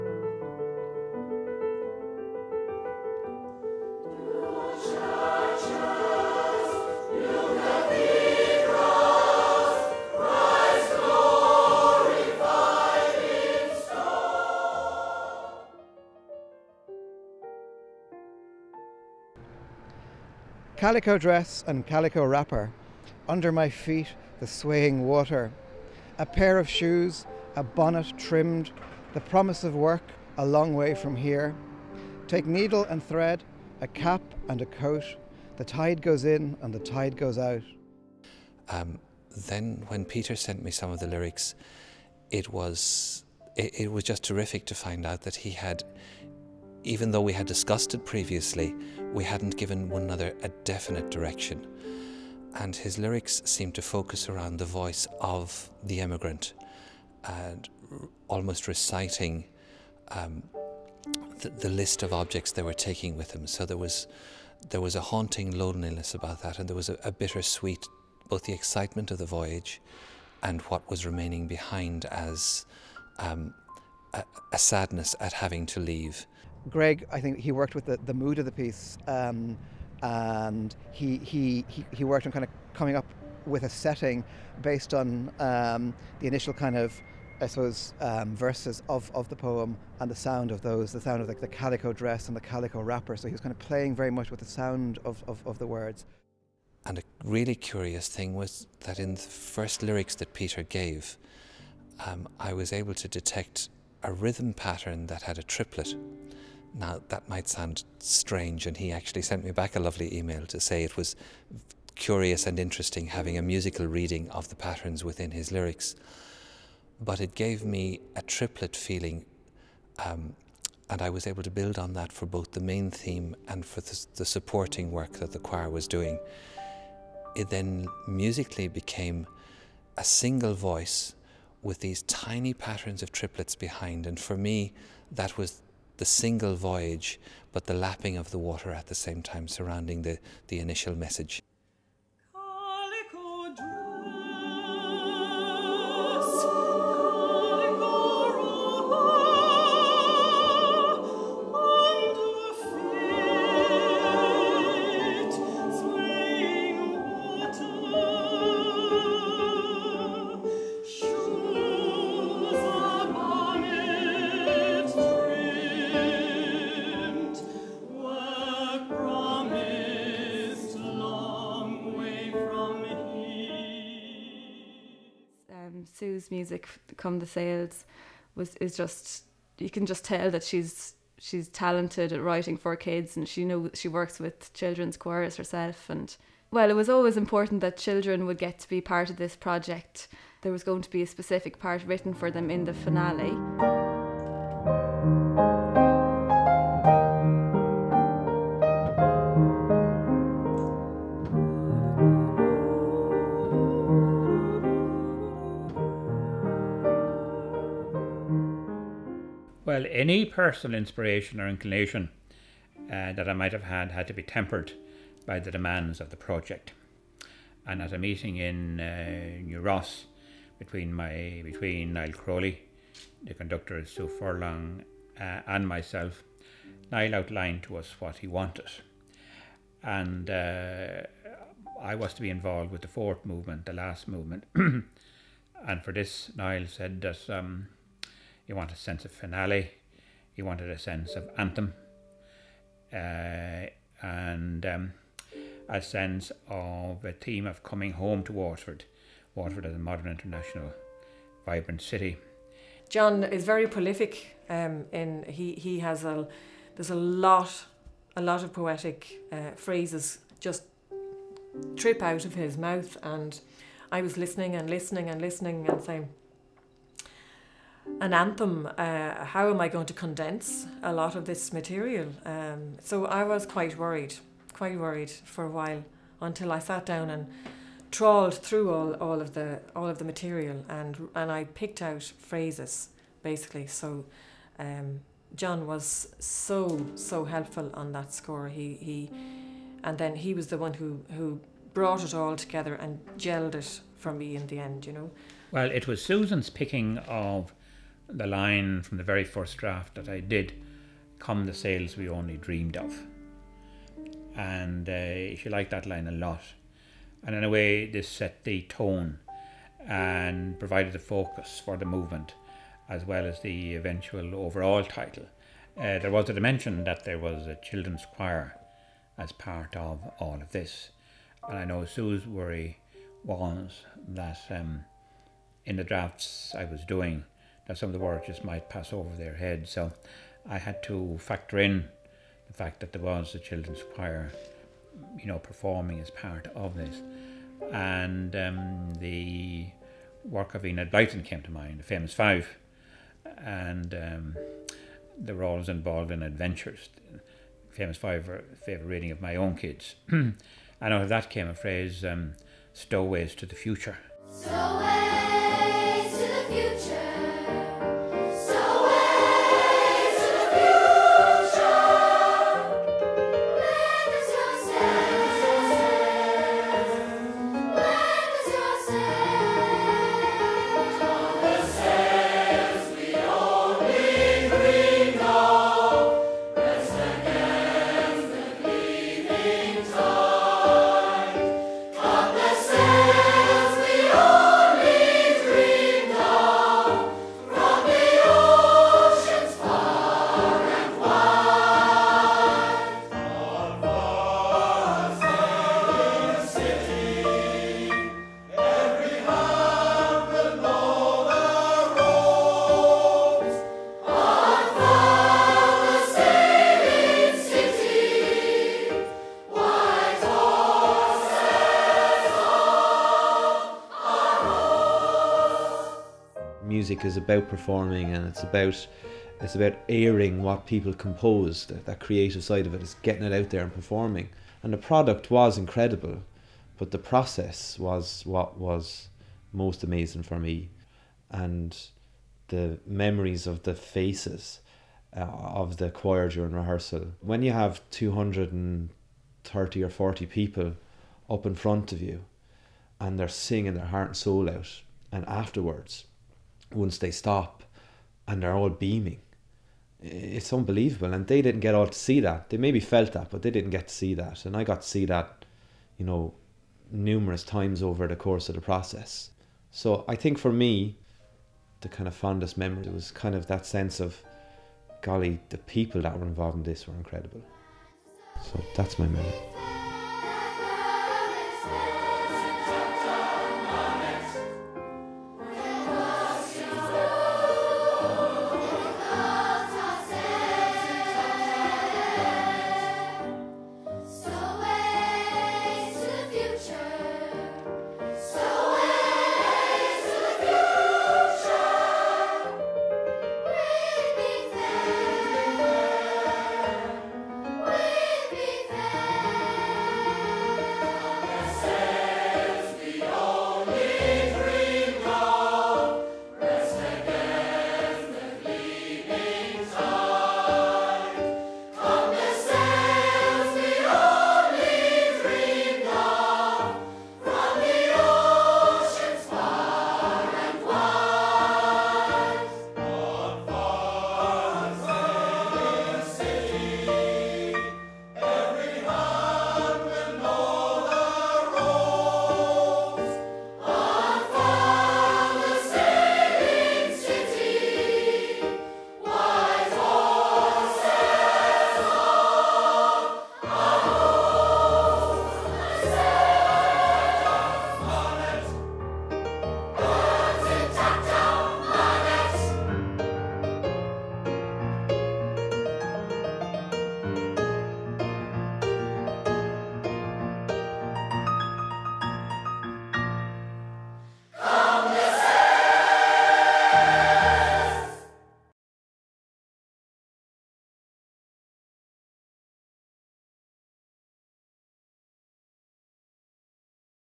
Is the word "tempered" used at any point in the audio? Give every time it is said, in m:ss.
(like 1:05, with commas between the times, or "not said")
3:34.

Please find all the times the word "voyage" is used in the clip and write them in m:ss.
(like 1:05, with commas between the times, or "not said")
1:09, 2:16.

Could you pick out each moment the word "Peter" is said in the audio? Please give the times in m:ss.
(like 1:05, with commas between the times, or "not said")
0:40, 1:40.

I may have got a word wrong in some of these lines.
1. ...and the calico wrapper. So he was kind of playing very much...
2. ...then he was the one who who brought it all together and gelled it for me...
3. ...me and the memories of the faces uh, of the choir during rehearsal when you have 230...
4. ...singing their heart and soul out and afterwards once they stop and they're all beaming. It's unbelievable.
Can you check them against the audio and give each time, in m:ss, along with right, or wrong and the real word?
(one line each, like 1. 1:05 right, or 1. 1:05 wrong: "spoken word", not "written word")
1. 1:32 right
2. 4:49 right
3. 7:10 right
4. 7:23 right.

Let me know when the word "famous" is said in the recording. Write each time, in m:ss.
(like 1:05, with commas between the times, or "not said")
5:41, 5:47.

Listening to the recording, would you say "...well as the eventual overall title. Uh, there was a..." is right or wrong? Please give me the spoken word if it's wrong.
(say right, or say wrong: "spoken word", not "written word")
right.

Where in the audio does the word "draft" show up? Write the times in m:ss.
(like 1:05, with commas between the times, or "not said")
4:59, 5:25.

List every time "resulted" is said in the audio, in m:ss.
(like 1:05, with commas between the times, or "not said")
not said.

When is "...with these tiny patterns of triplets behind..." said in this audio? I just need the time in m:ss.
2:11.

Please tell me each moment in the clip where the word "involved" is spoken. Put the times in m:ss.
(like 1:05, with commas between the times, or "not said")
3:52, 5:45, 7:46.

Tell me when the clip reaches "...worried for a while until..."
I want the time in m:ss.
4:34.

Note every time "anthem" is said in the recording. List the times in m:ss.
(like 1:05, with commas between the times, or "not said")
4:01, 4:28.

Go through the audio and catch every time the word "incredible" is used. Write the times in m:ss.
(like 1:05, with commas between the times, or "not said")
7:05, 7:46.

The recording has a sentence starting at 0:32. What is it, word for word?
Take needle and thread, a cap and a coat.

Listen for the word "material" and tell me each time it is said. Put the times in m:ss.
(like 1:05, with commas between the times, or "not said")
4:31, 4:40.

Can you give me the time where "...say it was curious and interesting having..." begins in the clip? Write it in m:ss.
1:50.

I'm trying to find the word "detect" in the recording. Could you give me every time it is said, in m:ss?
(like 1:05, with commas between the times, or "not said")
1:43.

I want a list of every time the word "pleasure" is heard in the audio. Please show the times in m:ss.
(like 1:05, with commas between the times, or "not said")
not said.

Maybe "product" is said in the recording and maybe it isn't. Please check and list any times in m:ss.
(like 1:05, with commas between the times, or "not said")
7:04.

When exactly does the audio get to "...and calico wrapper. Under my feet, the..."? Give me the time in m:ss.
0:21.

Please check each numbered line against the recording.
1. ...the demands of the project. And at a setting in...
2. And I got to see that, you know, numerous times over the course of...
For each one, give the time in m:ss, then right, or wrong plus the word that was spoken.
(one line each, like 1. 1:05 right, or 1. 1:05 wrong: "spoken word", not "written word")
1. 3:35 wrong: "meeting", not "setting"
2. 7:34 right.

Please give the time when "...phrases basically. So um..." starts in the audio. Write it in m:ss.
4:42.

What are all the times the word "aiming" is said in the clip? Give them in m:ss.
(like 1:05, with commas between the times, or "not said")
not said.